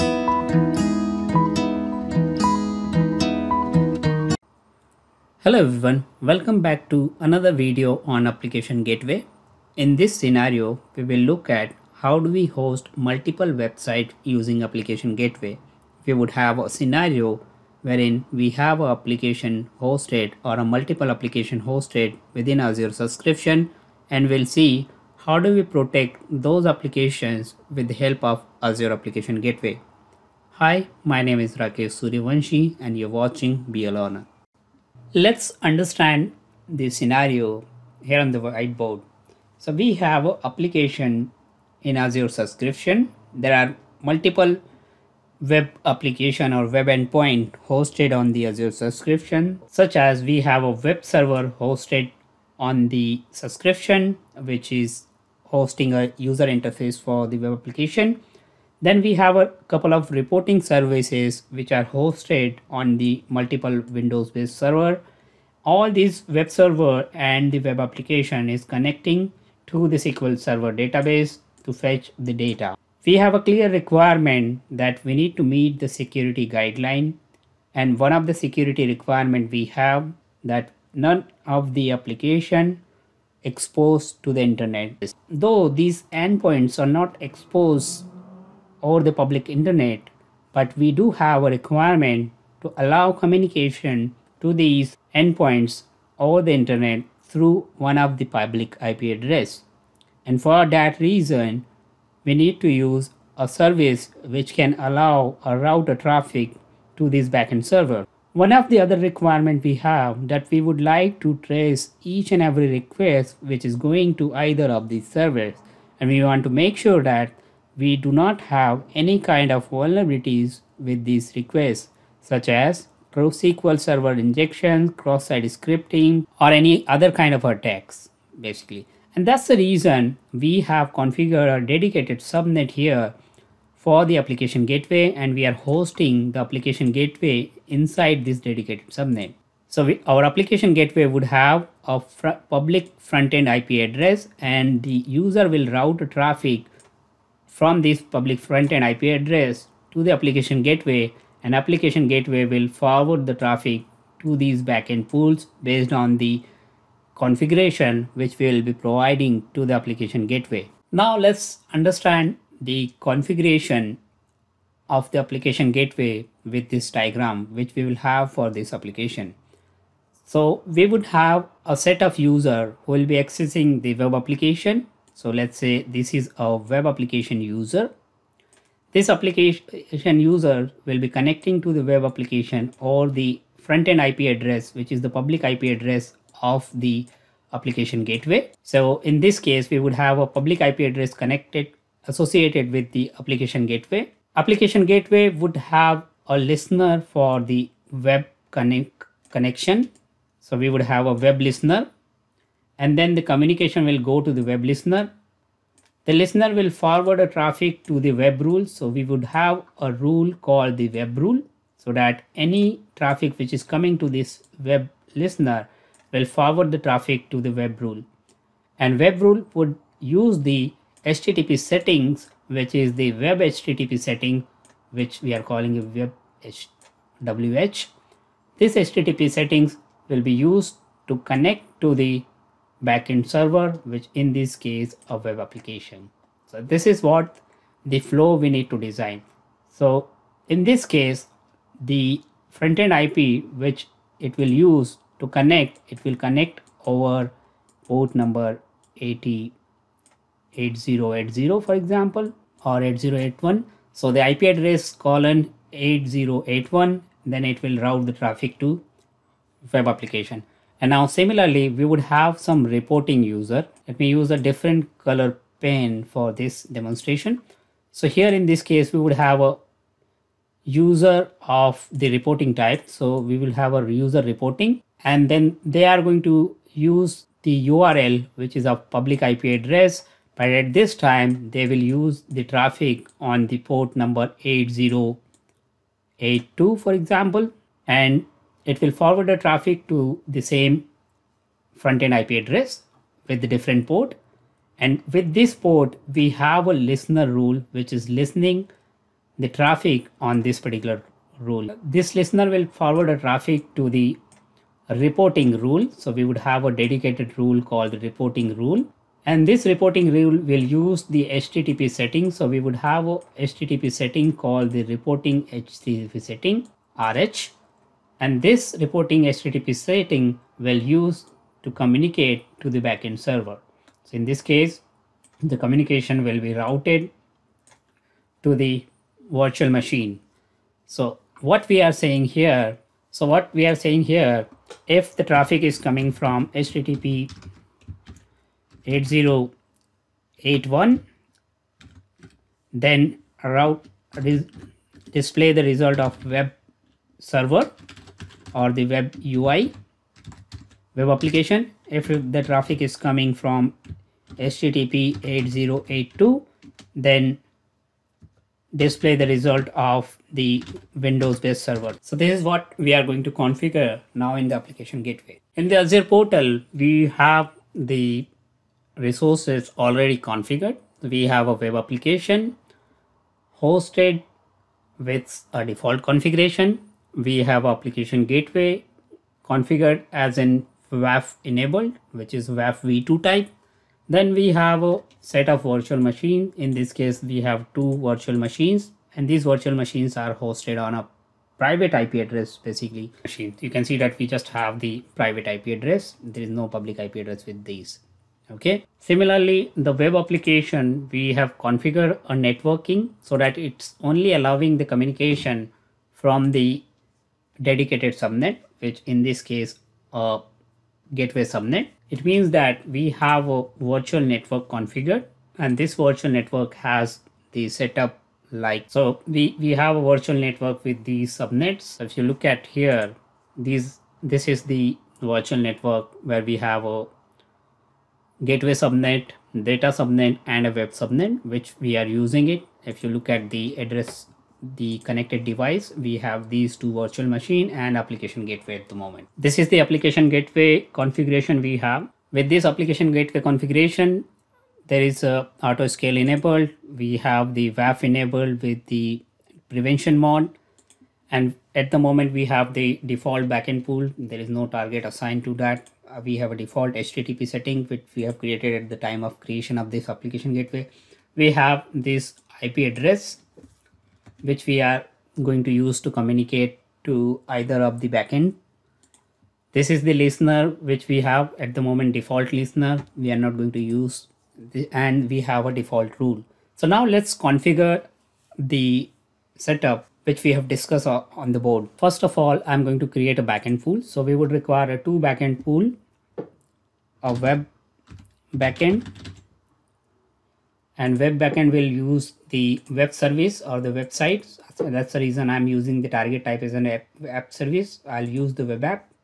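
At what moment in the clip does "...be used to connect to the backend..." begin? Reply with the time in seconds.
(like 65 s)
230 s.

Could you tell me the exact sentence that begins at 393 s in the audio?
You can see that we just have the private IP address.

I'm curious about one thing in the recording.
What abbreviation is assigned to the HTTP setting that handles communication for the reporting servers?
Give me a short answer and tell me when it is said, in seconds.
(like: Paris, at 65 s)
RH, at 316 s.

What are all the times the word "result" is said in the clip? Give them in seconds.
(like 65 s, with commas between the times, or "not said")
345 s, 359 s.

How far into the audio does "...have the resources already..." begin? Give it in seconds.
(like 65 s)
367 s.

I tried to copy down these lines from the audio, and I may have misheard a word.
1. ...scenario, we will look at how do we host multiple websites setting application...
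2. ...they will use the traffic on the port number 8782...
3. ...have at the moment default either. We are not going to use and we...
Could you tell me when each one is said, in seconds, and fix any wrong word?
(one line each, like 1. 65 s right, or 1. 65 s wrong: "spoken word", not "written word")
1. 10 s wrong: "using", not "setting"
2. 281 s wrong: "8082", not "8782"
3. 471 s wrong: "listener", not "either".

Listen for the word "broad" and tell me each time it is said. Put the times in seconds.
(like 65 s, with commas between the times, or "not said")
not said.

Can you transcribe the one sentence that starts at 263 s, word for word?
Let me use a different color pen for this demonstration.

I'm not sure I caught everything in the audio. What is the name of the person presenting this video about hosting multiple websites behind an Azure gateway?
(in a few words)
Rakesh Suryavanshi.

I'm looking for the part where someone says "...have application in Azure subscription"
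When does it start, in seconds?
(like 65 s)
39 s.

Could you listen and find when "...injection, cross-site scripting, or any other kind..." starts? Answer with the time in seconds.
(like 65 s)
124 s.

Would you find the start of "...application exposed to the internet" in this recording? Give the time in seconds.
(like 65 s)
81 s.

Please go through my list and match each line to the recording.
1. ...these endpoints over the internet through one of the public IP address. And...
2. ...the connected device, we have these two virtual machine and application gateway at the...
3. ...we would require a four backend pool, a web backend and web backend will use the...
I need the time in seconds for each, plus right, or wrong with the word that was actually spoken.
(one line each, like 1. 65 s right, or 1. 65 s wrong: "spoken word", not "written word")
1. 94 s right
2. 434 s right
3. 484 s wrong: "two", not "four".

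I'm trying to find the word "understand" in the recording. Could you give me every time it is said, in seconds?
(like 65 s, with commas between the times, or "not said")
35 s, 161 s.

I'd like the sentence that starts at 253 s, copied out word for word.
So the IP address colon 8081, then it will route the traffic to web application.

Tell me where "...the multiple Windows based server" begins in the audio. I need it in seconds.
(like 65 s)
62 s.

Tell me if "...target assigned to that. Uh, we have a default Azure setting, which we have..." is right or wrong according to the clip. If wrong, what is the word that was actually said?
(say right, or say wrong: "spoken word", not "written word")
wrong: "HTTP", not "Azure".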